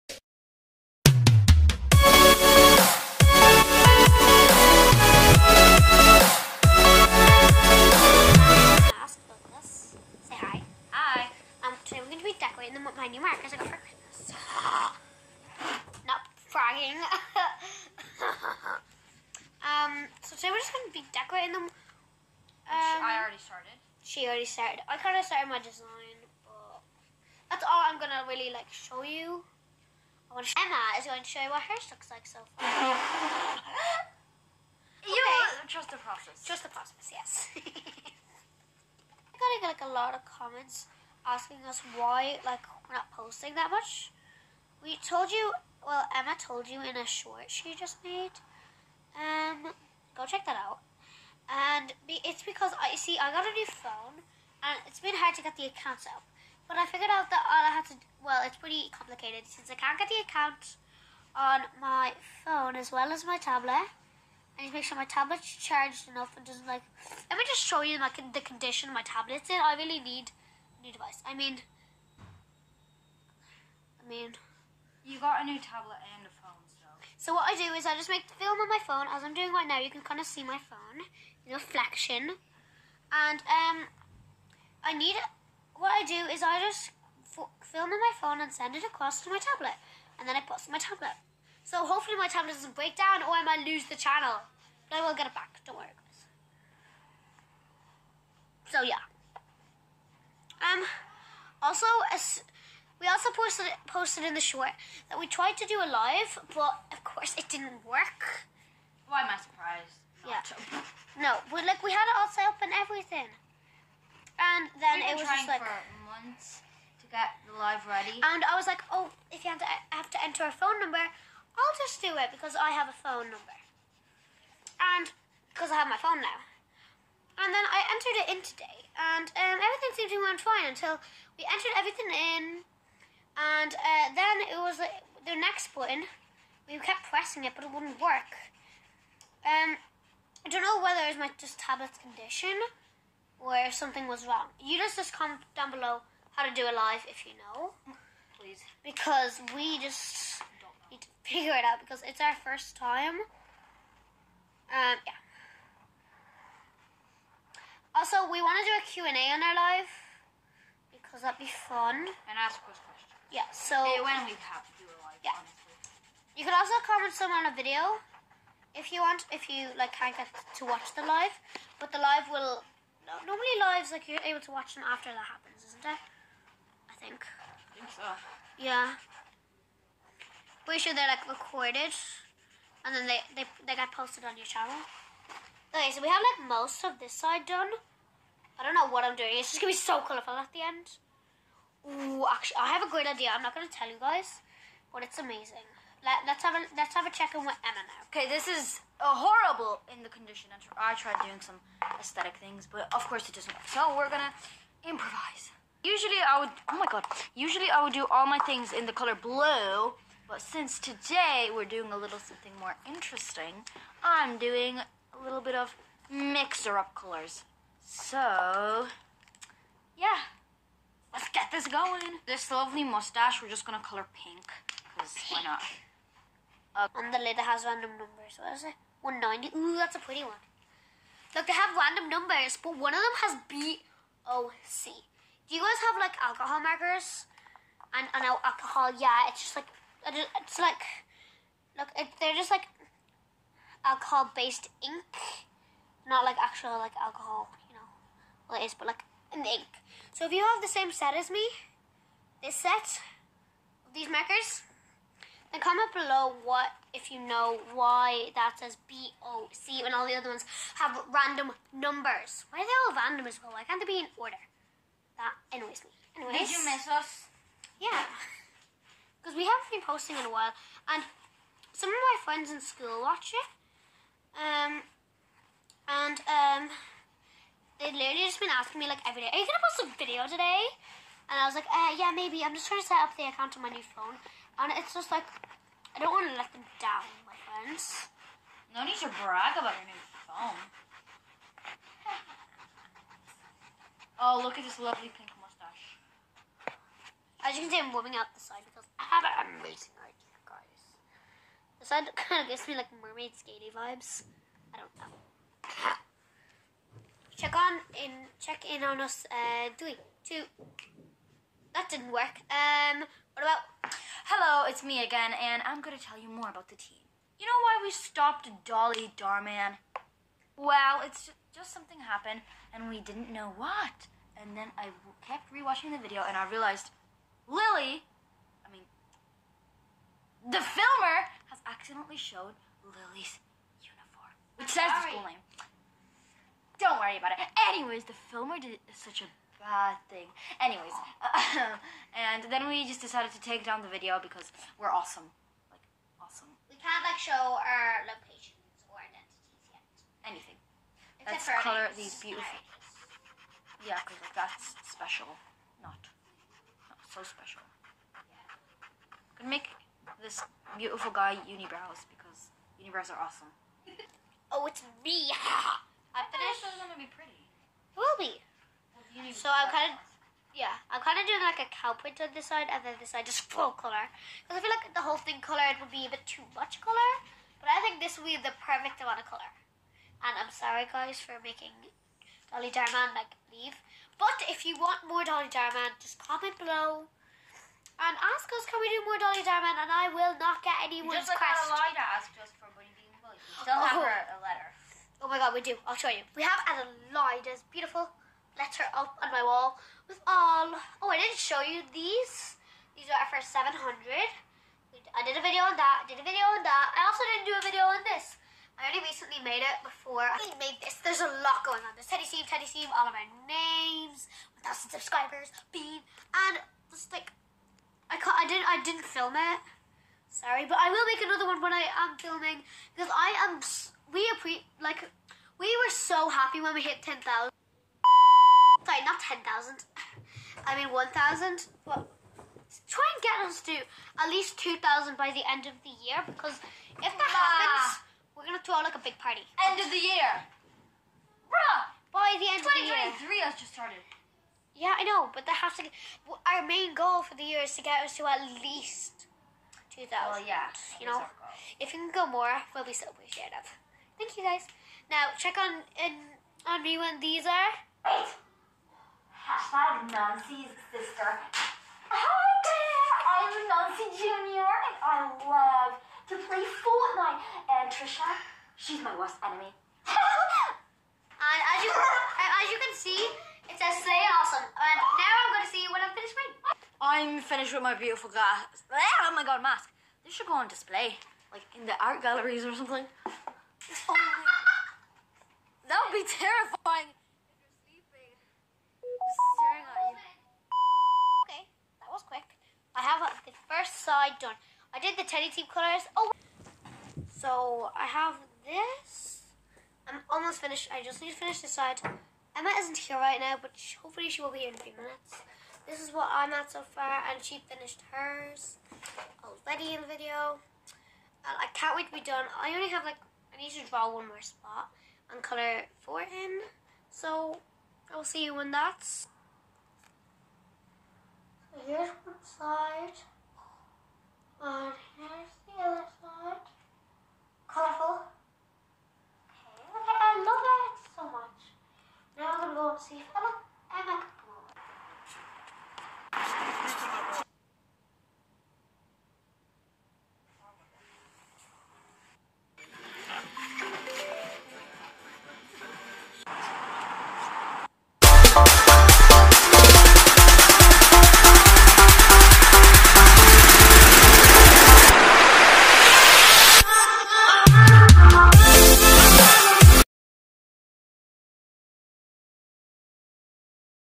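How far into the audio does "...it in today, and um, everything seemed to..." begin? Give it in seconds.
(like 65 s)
128 s.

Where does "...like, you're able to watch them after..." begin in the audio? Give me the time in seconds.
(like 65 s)
173 s.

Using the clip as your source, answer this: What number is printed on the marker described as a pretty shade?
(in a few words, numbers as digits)
190.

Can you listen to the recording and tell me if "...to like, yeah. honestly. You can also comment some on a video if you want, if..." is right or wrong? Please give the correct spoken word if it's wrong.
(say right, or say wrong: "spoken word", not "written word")
right.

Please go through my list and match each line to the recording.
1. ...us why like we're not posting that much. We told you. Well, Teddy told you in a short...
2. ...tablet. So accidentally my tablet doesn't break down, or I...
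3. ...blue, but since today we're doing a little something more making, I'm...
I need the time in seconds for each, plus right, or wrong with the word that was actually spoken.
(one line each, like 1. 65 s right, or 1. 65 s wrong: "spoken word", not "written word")
1. 41 s wrong: "Emma", not "Teddy"
2. 90 s wrong: "hopefully", not "accidentally"
3. 209 s wrong: "interesting", not "making".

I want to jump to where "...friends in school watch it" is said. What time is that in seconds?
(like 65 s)
272 s.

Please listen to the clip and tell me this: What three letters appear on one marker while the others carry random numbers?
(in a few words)
BOC.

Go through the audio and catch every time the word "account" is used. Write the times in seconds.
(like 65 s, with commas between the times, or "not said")
55 s, 60 s, 283 s.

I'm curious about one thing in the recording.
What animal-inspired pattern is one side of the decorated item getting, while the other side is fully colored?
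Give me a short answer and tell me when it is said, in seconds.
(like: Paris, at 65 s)
cow print, at 371 s.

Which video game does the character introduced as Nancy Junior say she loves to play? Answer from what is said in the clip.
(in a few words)
Fortnite.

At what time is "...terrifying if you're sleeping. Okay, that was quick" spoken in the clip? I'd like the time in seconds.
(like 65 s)
486 s.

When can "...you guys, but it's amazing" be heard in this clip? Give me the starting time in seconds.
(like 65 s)
193 s.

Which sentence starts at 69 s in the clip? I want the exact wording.
I really need a new device.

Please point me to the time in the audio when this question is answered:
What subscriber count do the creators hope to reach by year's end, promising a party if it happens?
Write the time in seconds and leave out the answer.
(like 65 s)
434 s.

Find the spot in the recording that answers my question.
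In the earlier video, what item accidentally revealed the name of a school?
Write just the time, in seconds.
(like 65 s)
332 s.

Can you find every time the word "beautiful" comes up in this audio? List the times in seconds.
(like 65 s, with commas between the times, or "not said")
352 s, 360 s, 397 s, 477 s.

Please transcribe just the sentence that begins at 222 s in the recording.
This lovely mustache, we're just gonna color pink.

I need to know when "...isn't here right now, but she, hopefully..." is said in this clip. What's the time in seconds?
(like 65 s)
502 s.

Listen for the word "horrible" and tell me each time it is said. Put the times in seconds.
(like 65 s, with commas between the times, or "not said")
199 s.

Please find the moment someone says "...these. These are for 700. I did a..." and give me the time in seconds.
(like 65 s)
401 s.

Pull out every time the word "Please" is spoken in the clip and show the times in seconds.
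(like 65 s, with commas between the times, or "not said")
148 s.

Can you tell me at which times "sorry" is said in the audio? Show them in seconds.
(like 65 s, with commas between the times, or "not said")
337 s, 380 s, 420 s, 428 s.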